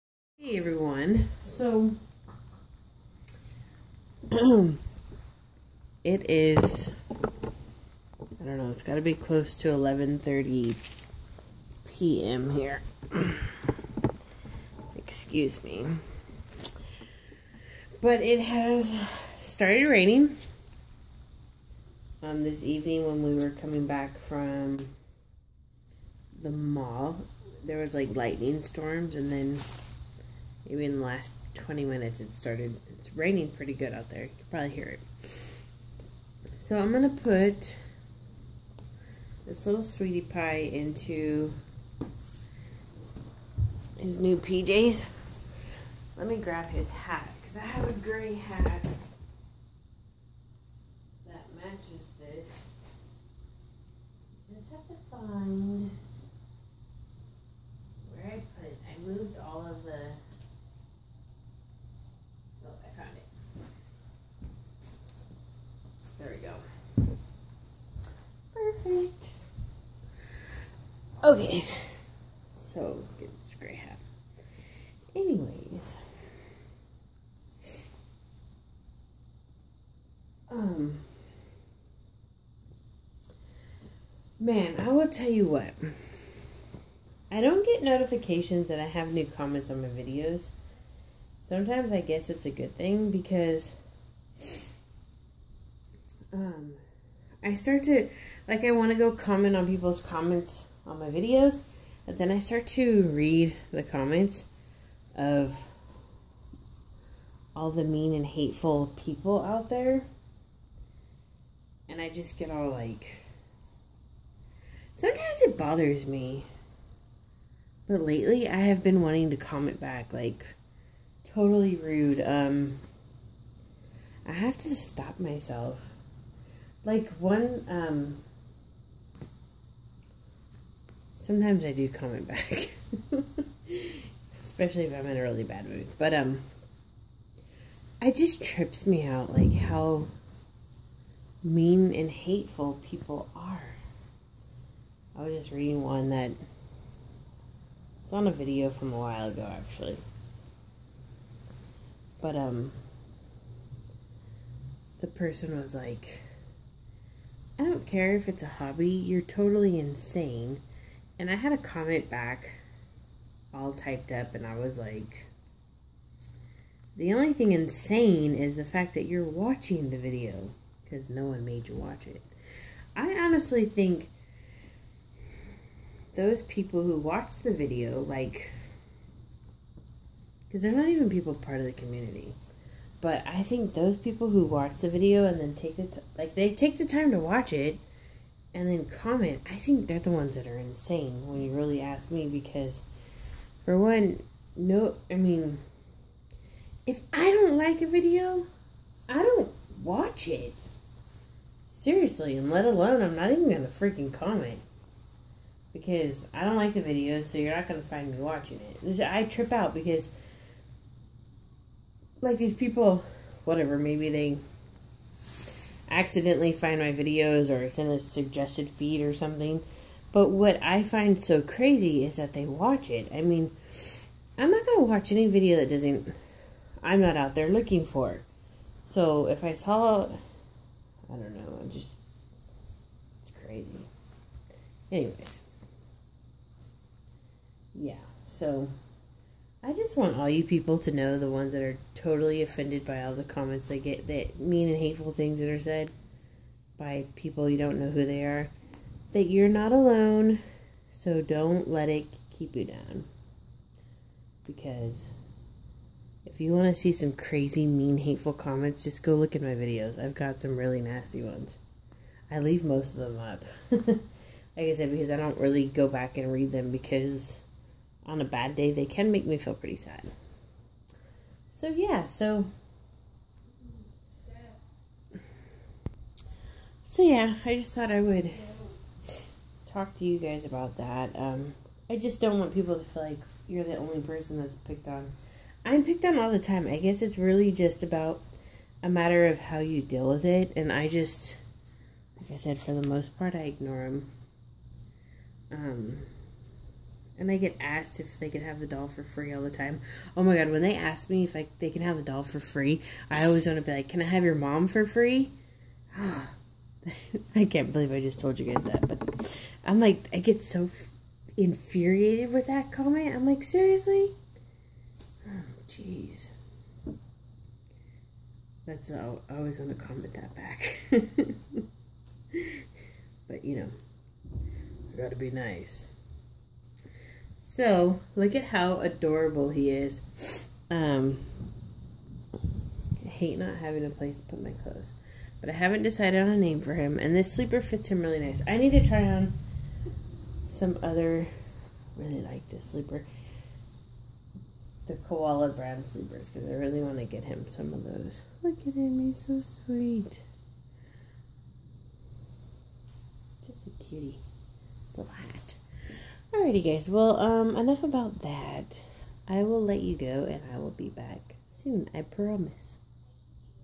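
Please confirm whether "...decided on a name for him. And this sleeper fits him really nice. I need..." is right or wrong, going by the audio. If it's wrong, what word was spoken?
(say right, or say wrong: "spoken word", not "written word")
right.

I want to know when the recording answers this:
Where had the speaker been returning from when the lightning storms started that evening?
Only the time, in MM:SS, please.
00:26.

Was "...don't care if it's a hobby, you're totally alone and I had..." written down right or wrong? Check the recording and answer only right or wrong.
wrong.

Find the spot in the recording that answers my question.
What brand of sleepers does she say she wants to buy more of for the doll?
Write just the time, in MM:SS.
05:45.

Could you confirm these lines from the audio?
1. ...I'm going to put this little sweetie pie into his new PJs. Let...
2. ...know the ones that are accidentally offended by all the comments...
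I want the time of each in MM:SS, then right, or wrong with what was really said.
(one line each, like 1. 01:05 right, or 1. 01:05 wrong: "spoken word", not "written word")
1. 00:36 right
2. 04:00 wrong: "totally", not "accidentally".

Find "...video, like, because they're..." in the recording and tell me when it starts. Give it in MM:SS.
02:57.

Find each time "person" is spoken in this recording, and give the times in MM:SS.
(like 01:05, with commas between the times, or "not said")
02:35, 04:44.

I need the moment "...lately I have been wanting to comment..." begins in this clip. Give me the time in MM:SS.
01:58.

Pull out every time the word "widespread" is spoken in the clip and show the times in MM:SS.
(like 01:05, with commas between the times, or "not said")
not said.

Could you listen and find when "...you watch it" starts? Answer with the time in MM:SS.
02:51.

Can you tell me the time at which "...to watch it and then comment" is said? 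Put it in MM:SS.
03:07.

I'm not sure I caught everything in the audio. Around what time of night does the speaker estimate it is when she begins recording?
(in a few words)
11:30 p.m.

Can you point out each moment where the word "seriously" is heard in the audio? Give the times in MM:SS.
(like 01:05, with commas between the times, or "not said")
03:21, 05:13.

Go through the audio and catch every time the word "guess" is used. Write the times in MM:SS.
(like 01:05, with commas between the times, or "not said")
01:32, 04:46.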